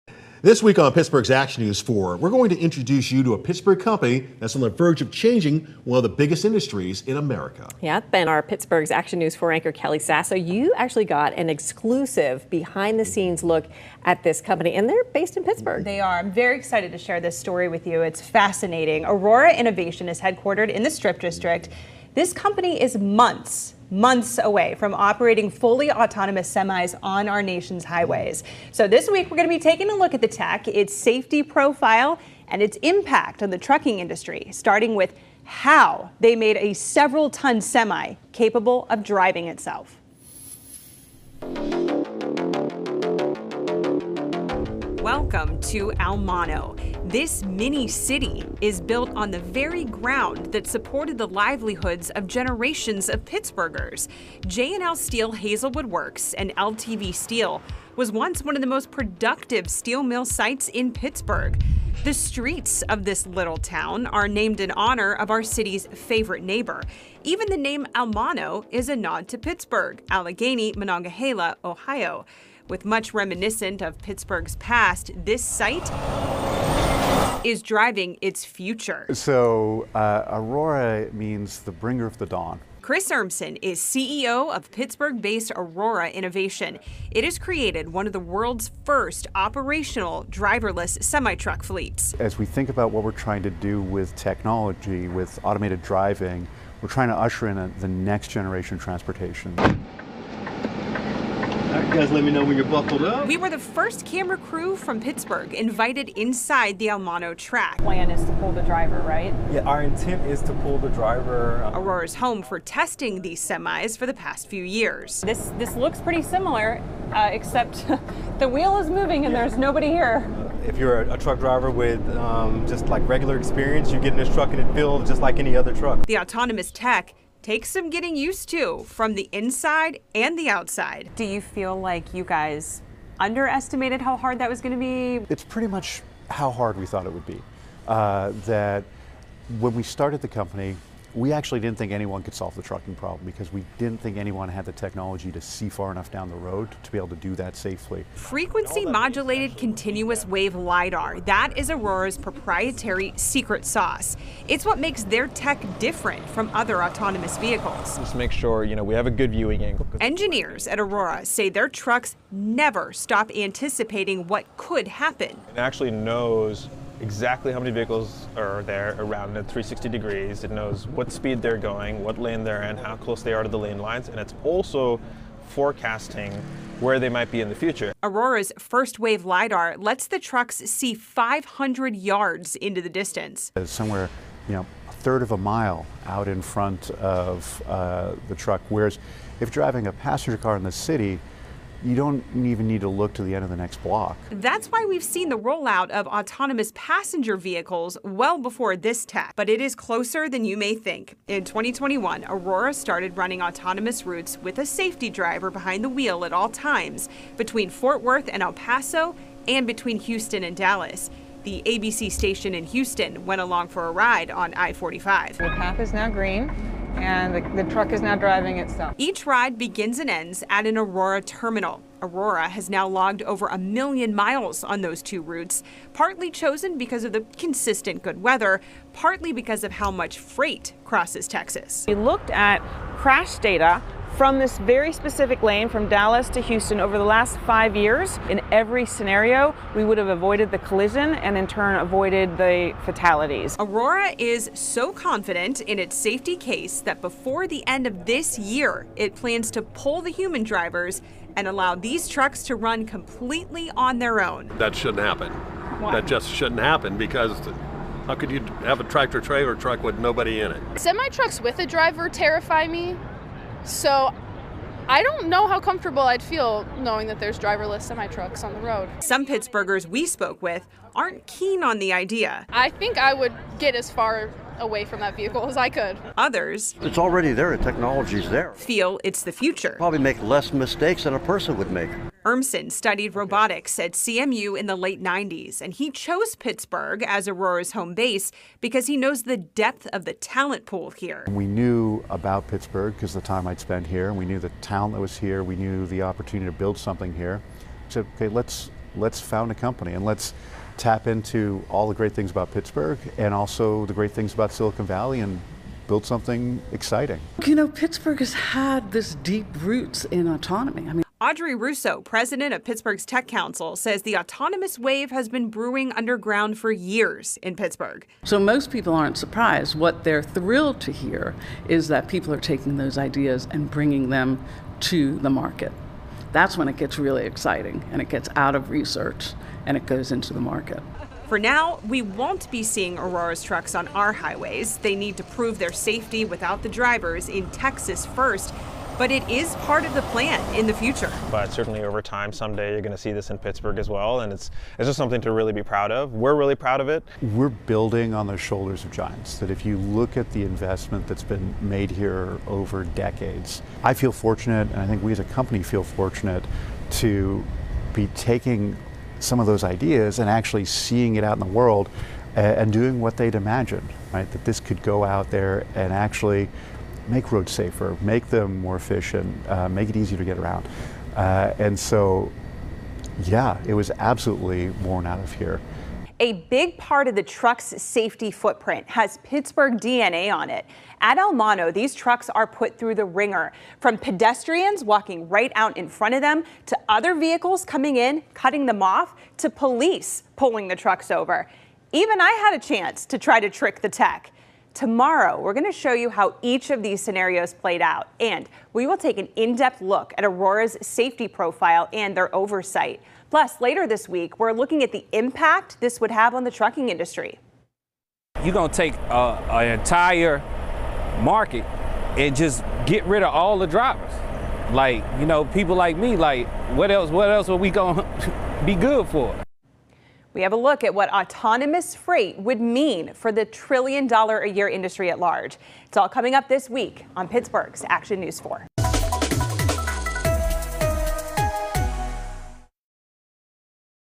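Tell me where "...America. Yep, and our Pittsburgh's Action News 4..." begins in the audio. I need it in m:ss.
0:07.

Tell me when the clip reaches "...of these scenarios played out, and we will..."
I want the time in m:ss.
6:36.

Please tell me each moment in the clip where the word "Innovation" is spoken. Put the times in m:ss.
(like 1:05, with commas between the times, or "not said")
0:19, 1:26.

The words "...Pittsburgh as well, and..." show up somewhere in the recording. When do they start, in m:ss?
5:43.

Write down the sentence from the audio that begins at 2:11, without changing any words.
Do you feel like you guys underestimated how hard that was going to be?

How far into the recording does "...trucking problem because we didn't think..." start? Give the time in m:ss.
2:22.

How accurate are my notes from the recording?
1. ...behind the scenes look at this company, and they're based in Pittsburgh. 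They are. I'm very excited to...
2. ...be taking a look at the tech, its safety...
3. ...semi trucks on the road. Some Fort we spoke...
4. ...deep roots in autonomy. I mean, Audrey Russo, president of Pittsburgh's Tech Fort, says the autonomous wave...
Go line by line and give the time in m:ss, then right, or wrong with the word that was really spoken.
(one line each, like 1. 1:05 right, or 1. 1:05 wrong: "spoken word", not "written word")
1. 0:12 right
2. 0:29 right
3. 4:27 wrong: "Pittsburghers", not "Fort"
4. 5:09 wrong: "Council", not "Fort".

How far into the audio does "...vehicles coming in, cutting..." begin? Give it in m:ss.
6:27.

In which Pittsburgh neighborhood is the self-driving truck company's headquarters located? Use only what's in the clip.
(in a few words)
Strip District.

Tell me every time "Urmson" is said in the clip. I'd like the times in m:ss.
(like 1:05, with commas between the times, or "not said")
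1:23, 4:42.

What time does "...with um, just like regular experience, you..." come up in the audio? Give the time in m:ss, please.
2:01.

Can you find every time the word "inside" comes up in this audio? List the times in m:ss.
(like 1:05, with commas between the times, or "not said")
1:46, 2:09.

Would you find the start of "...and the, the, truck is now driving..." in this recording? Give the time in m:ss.
3:36.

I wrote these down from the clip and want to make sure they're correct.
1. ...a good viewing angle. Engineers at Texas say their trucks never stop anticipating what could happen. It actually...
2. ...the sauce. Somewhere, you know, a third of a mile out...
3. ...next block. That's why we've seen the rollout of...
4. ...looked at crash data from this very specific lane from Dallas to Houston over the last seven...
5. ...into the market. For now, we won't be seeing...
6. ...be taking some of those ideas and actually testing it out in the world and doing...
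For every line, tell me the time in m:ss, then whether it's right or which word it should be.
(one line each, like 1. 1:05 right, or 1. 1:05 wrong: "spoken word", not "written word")
1. 2:39 wrong: "Aurora", not "Texas"
2. 3:02 wrong: "distance", not "sauce"
3. 3:13 right
4. 3:51 wrong: "five", not "seven"
5. 5:30 right
6. 5:57 wrong: "seeing", not "testing".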